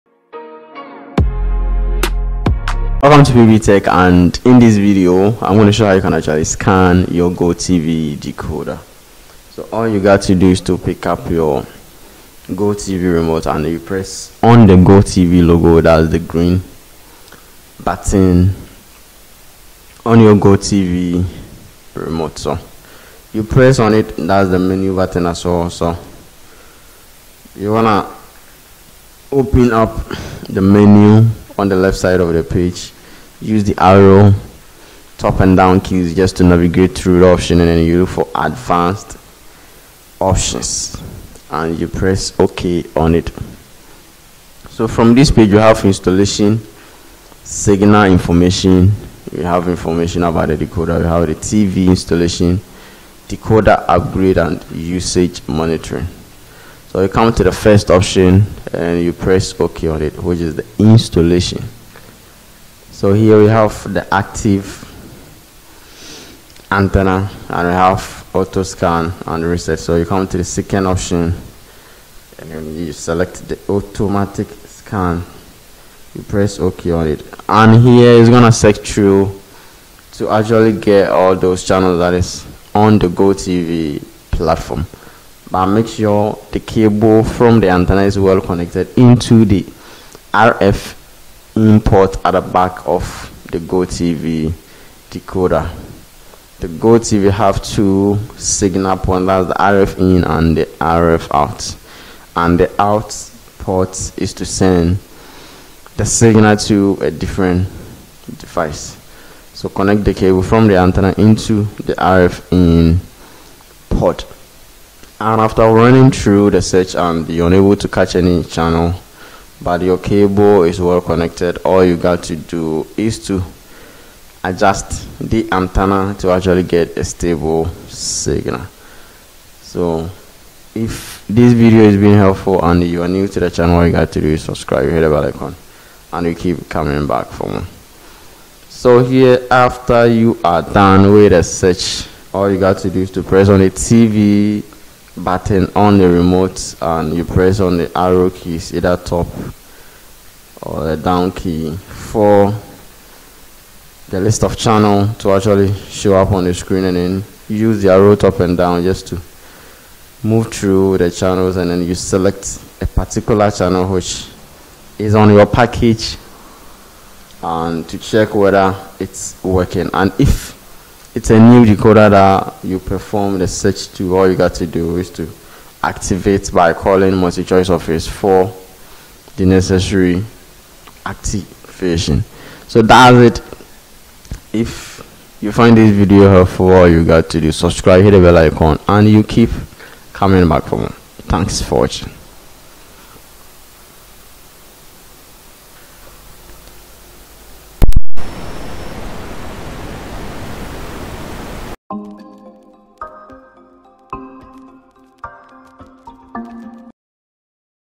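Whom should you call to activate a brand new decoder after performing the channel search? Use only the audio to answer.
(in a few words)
MultiChoice office.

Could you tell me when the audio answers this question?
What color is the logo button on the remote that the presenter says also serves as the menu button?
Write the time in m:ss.
0:16.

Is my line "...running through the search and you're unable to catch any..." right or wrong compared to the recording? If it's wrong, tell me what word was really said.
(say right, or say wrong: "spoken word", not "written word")
right.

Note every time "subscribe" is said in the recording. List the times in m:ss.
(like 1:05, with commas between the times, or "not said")
2:14, 3:07.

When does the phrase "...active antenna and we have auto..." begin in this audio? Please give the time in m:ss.
1:04.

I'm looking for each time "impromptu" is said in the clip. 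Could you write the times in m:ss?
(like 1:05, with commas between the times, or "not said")
not said.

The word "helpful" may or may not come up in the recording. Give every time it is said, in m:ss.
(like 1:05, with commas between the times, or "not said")
2:12, 3:06.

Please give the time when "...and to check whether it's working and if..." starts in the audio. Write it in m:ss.
2:47.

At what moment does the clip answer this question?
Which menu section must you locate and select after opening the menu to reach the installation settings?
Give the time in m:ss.
0:38.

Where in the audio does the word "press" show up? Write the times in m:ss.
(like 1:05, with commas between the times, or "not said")
0:13, 0:23, 0:41, 0:59, 1:16, 2:23, 2:27.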